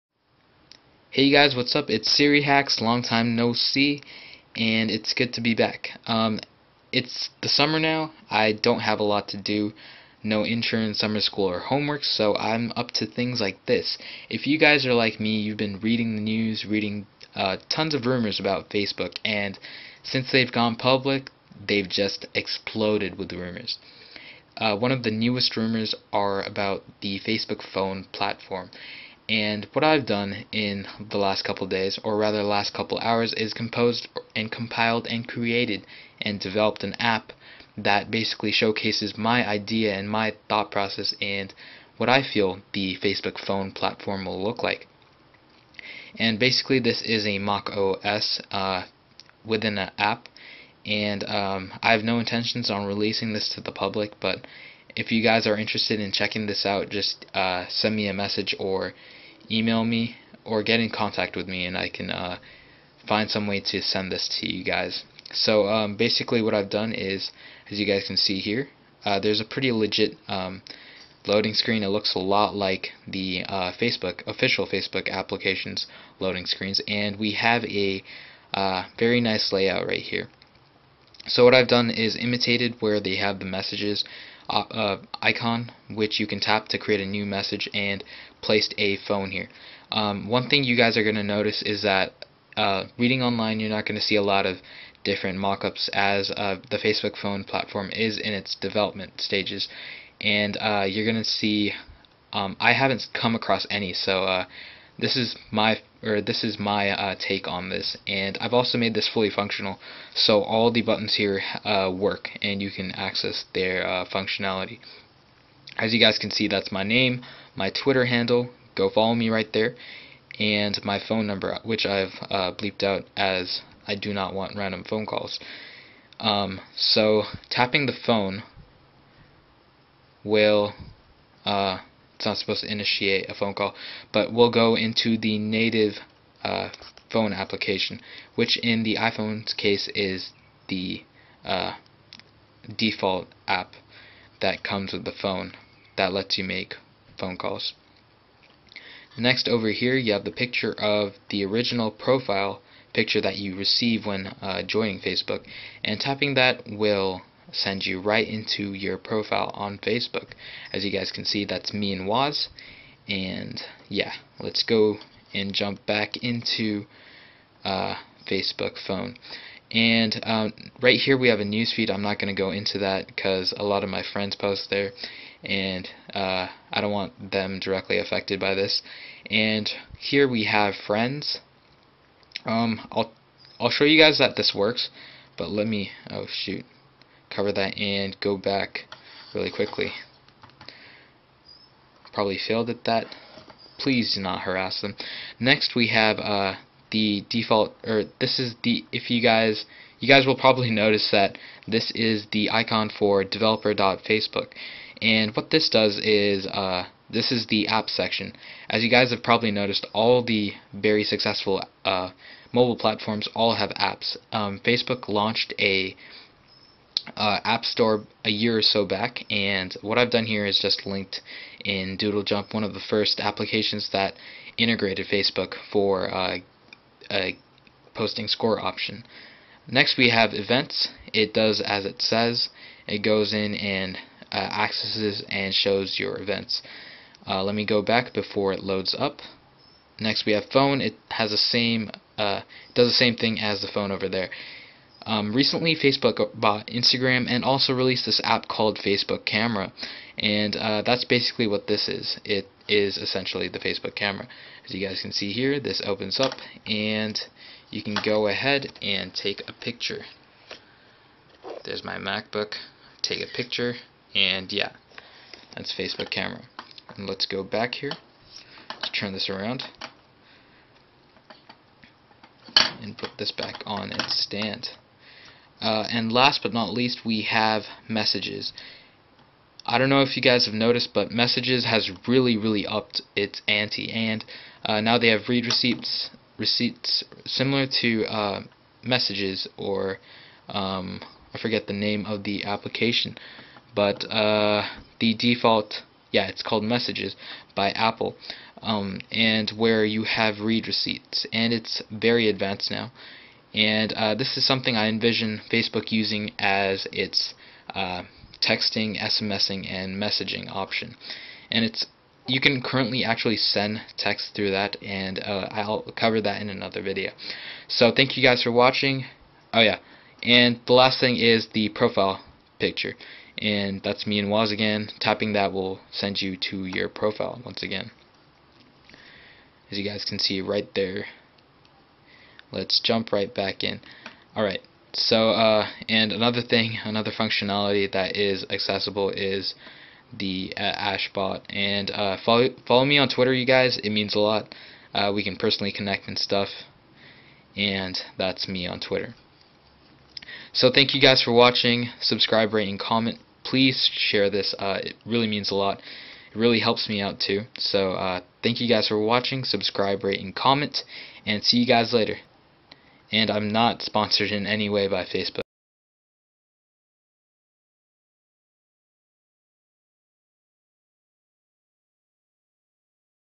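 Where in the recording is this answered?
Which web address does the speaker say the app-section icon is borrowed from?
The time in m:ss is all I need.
3:23.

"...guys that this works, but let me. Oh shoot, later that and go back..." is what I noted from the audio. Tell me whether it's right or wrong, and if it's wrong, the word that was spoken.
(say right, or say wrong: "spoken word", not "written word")
wrong: "cover", not "later".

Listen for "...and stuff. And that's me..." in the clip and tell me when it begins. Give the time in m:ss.
5:46.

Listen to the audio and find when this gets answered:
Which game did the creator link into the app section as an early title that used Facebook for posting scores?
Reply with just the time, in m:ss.
3:41.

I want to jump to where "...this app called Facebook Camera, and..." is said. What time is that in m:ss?
4:08.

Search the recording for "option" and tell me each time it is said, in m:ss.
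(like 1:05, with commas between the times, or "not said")
3:48, 5:10.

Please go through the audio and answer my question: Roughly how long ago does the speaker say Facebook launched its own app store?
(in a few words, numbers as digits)
a year or so.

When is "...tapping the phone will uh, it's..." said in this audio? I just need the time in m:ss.
2:07.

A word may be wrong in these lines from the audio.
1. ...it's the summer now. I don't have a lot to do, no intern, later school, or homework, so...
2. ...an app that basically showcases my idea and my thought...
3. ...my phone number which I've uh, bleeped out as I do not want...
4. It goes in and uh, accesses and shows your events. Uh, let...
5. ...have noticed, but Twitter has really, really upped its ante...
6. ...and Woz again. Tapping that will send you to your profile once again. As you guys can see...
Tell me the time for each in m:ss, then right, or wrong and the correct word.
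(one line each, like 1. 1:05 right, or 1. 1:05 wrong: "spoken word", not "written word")
1. 0:06 wrong: "summer", not "later"
2. 0:36 right
3. 2:00 right
4. 3:52 right
5. 4:40 wrong: "Messages", not "Twitter"
6. 5:24 right.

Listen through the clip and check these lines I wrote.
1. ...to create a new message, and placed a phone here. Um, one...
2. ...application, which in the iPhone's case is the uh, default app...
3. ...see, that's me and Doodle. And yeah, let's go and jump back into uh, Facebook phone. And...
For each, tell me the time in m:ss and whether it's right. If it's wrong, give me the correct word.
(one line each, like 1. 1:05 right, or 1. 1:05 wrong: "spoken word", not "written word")
1. 1:26 right
2. 2:17 right
3. 2:41 wrong: "Woz", not "Doodle".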